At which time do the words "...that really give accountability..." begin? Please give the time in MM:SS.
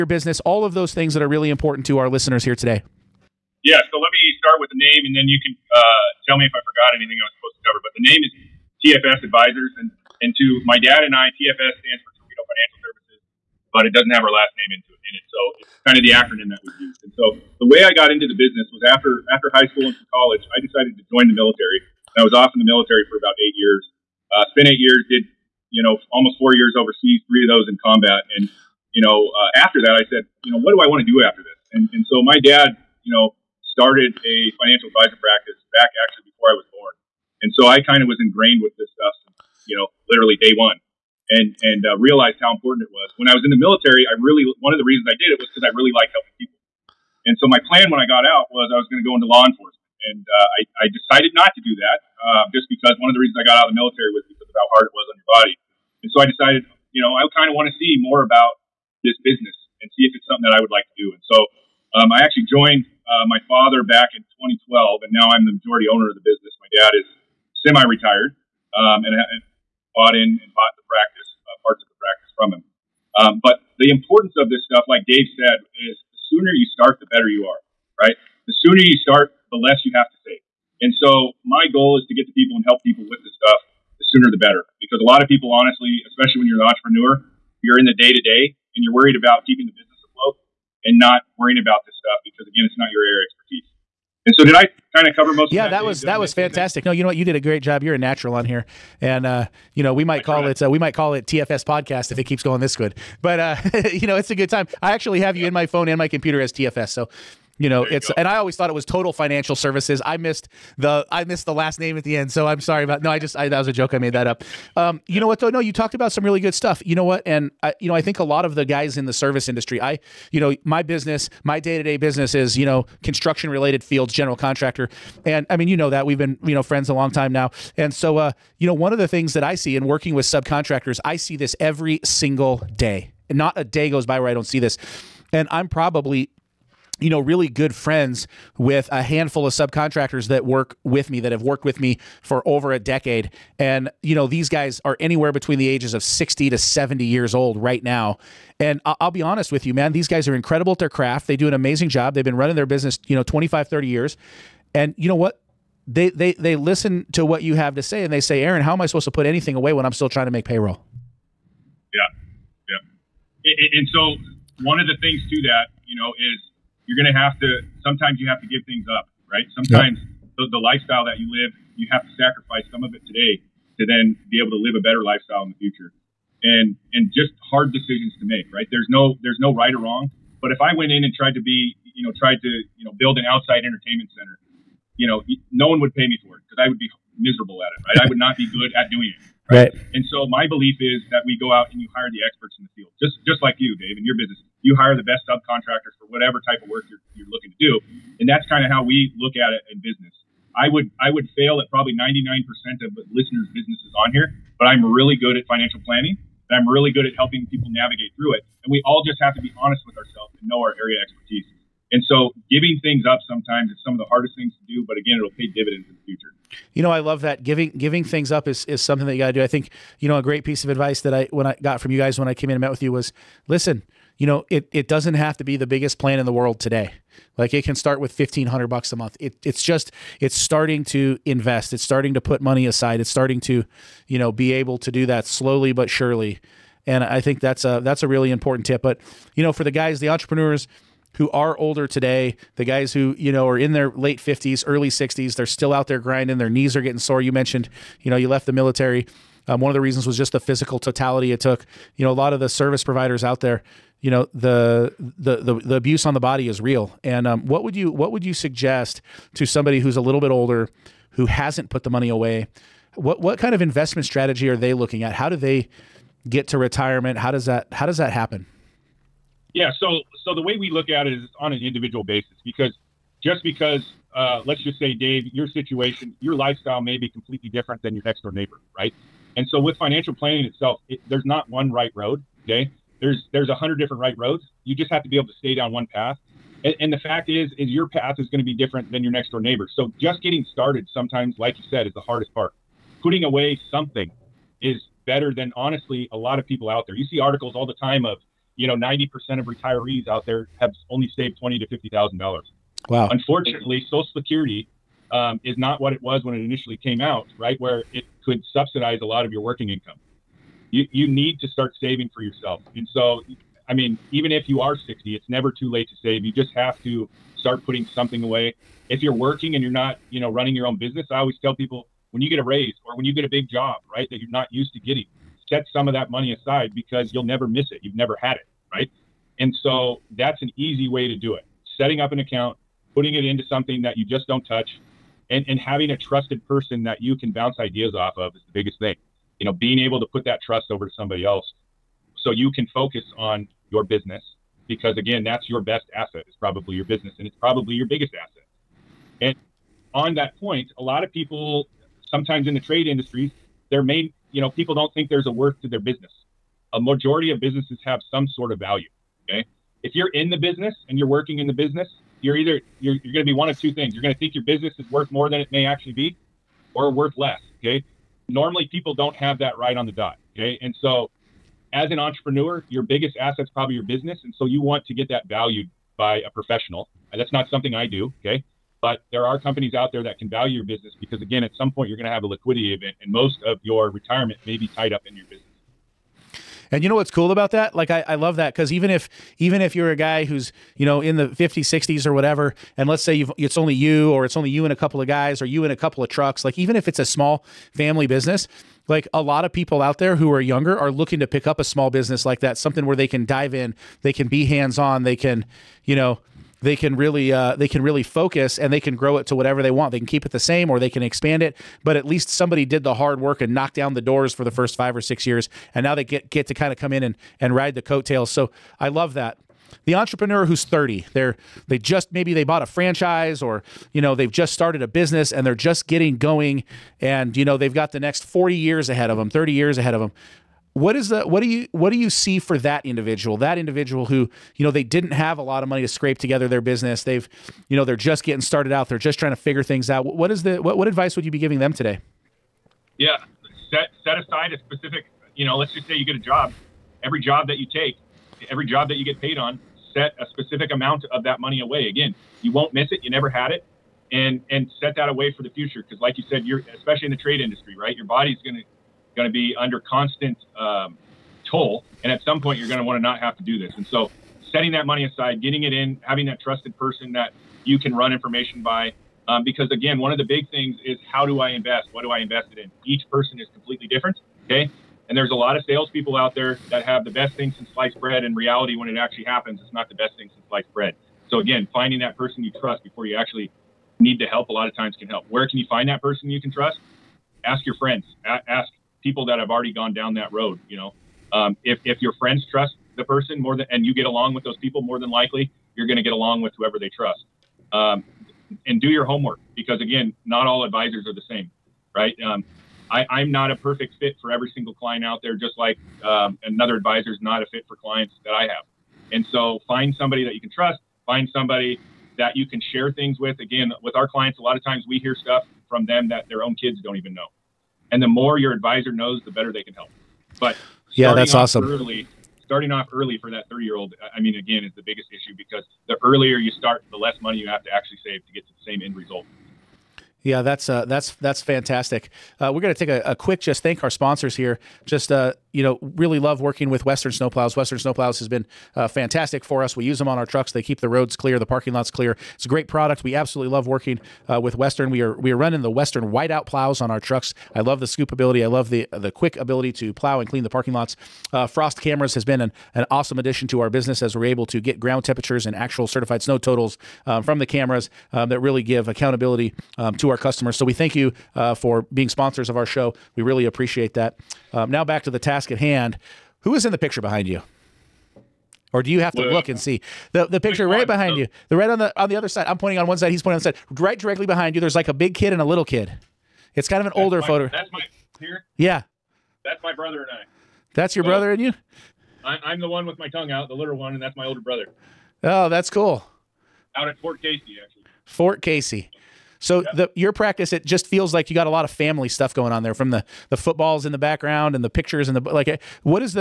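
09:18.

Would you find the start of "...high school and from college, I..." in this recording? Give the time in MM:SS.
00:19.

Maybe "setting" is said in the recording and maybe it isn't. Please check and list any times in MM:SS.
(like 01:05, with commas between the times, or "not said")
05:31, 07:44.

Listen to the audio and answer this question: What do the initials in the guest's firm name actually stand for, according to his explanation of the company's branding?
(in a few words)
Terwedo Financial Services.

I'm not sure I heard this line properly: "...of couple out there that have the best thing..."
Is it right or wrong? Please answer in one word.
wrong.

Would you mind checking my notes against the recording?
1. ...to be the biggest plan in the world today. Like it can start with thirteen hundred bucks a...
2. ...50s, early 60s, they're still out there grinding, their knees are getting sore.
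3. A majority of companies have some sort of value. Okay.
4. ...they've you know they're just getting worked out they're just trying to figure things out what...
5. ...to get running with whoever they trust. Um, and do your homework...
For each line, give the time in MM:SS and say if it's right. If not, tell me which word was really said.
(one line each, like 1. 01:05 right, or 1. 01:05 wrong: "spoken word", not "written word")
1. 03:45 wrong: "fifteen", not "thirteen"
2. 04:04 right
3. 05:56 wrong: "businesses", not "companies"
4. 07:17 wrong: "started", not "worked"
5. 08:15 wrong: "along", not "running".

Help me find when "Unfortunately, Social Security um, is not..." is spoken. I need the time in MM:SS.
05:03.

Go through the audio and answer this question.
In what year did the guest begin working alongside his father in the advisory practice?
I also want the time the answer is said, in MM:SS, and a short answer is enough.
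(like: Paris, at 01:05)
2012, at 01:04.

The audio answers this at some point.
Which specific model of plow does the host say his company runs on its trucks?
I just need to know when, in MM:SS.
09:05.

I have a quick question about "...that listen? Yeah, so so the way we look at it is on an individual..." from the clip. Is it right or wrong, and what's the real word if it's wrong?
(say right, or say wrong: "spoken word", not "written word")
wrong: "happen", not "listen".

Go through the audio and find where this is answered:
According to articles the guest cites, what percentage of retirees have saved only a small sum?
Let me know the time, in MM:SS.
04:58.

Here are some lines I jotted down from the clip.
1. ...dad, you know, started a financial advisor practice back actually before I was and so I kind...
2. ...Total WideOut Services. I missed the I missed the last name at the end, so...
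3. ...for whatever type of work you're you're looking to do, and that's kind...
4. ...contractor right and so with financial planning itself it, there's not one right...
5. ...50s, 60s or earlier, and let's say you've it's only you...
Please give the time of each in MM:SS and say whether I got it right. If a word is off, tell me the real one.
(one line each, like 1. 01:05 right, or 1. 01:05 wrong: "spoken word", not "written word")
1. 00:32 right
2. 01:48 wrong: "Financial", not "WideOut"
3. 03:15 right
4. 04:38 wrong: "neighbor", not "contractor"
5. 06:31 wrong: "whatever", not "earlier".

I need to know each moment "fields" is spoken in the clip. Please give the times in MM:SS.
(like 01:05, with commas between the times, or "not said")
02:03, 03:12.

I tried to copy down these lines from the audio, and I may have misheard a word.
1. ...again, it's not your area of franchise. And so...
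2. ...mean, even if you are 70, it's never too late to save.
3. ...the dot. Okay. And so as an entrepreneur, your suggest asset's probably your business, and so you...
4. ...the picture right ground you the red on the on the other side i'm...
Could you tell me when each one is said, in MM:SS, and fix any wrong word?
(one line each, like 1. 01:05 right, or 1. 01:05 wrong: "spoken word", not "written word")
1. 01:32 wrong: "expertise", not "franchise"
2. 05:13 wrong: "60", not "70"
3. 06:09 wrong: "biggest", not "suggest"
4. 09:30 wrong: "behind", not "ground".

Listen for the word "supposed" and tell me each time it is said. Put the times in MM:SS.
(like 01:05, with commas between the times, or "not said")
00:07, 02:38.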